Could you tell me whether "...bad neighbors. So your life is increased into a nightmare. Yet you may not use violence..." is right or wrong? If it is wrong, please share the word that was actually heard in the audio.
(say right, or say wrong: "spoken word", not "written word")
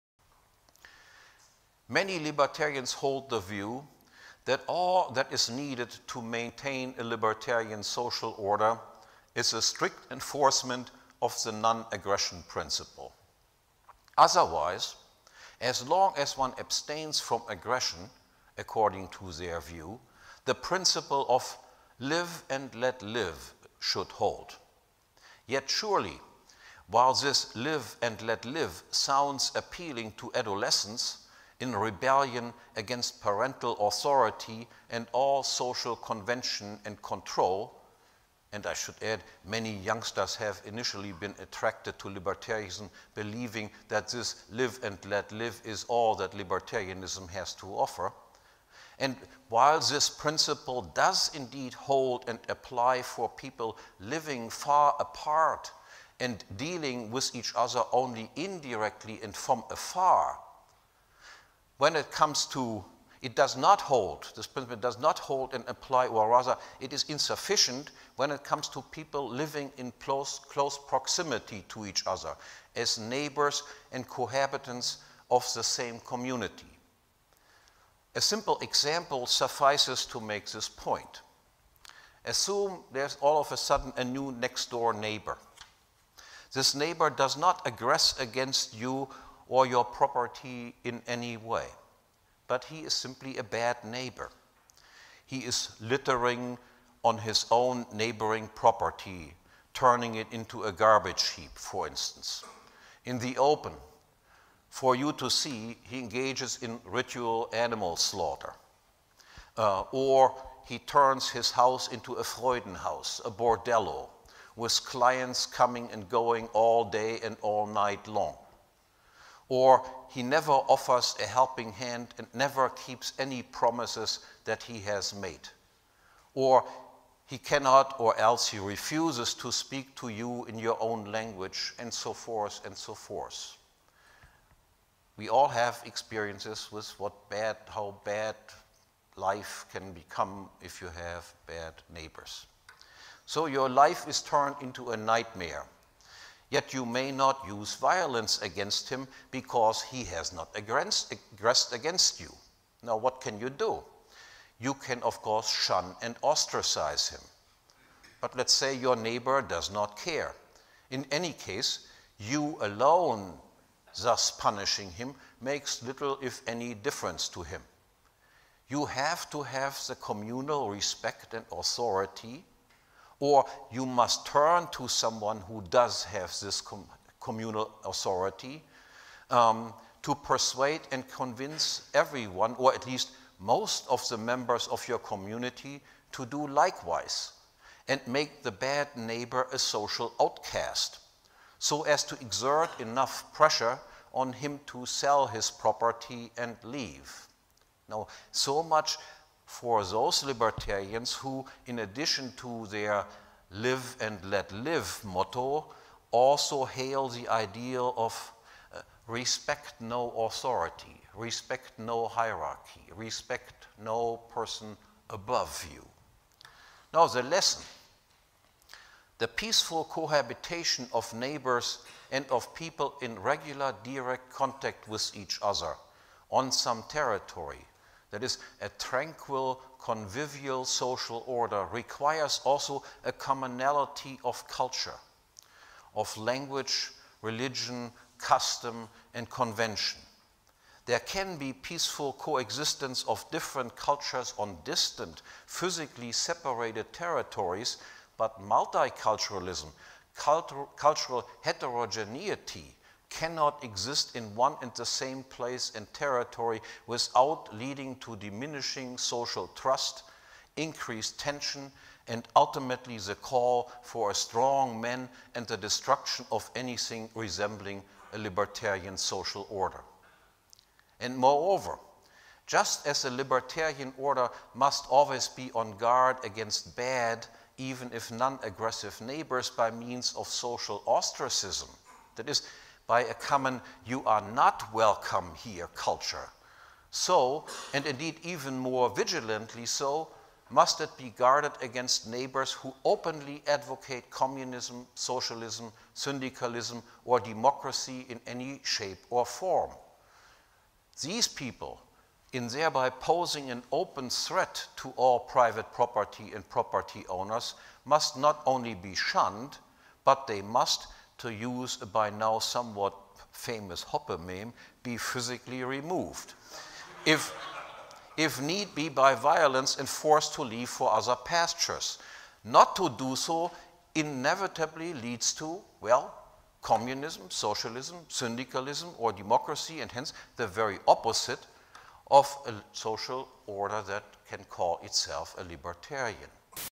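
wrong: "turned", not "increased".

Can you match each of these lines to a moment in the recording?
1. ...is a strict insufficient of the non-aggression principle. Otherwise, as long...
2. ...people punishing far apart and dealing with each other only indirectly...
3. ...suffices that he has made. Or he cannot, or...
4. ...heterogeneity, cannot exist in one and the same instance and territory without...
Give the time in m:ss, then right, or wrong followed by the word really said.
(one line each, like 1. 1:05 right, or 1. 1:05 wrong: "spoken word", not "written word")
1. 0:09 wrong: "enforcement", not "insufficient"
2. 0:53 wrong: "living", not "punishing"
3. 2:03 wrong: "promises", not "suffices"
4. 4:11 wrong: "place", not "instance".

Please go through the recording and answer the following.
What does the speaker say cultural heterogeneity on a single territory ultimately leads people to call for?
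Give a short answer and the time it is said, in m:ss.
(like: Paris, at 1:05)
a strong man, at 4:24.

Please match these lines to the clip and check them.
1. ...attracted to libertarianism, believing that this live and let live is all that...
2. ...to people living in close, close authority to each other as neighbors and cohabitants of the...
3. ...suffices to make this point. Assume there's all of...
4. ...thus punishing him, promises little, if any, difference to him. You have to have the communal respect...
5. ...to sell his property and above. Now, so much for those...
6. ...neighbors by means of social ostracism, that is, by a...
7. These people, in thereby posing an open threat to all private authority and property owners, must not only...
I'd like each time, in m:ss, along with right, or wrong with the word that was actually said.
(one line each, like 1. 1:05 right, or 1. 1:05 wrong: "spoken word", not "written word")
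1. 0:41 right
2. 1:08 wrong: "proximity", not "authority"
3. 1:19 right
4. 2:44 wrong: "makes", not "promises"
5. 3:14 wrong: "leave", not "above"
6. 4:39 right
7. 5:01 wrong: "property", not "authority".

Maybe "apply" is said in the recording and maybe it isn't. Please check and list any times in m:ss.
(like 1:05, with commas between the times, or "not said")
0:52, 1:05.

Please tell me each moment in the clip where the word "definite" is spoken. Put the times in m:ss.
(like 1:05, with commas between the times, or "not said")
not said.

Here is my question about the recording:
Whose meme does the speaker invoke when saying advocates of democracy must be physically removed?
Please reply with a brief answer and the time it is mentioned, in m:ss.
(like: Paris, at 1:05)
Hoppean, at 5:13.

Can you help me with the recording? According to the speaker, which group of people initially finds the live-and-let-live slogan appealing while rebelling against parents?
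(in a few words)
adolescents.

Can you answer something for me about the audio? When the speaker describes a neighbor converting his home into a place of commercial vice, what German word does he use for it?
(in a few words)
Freudenhaus.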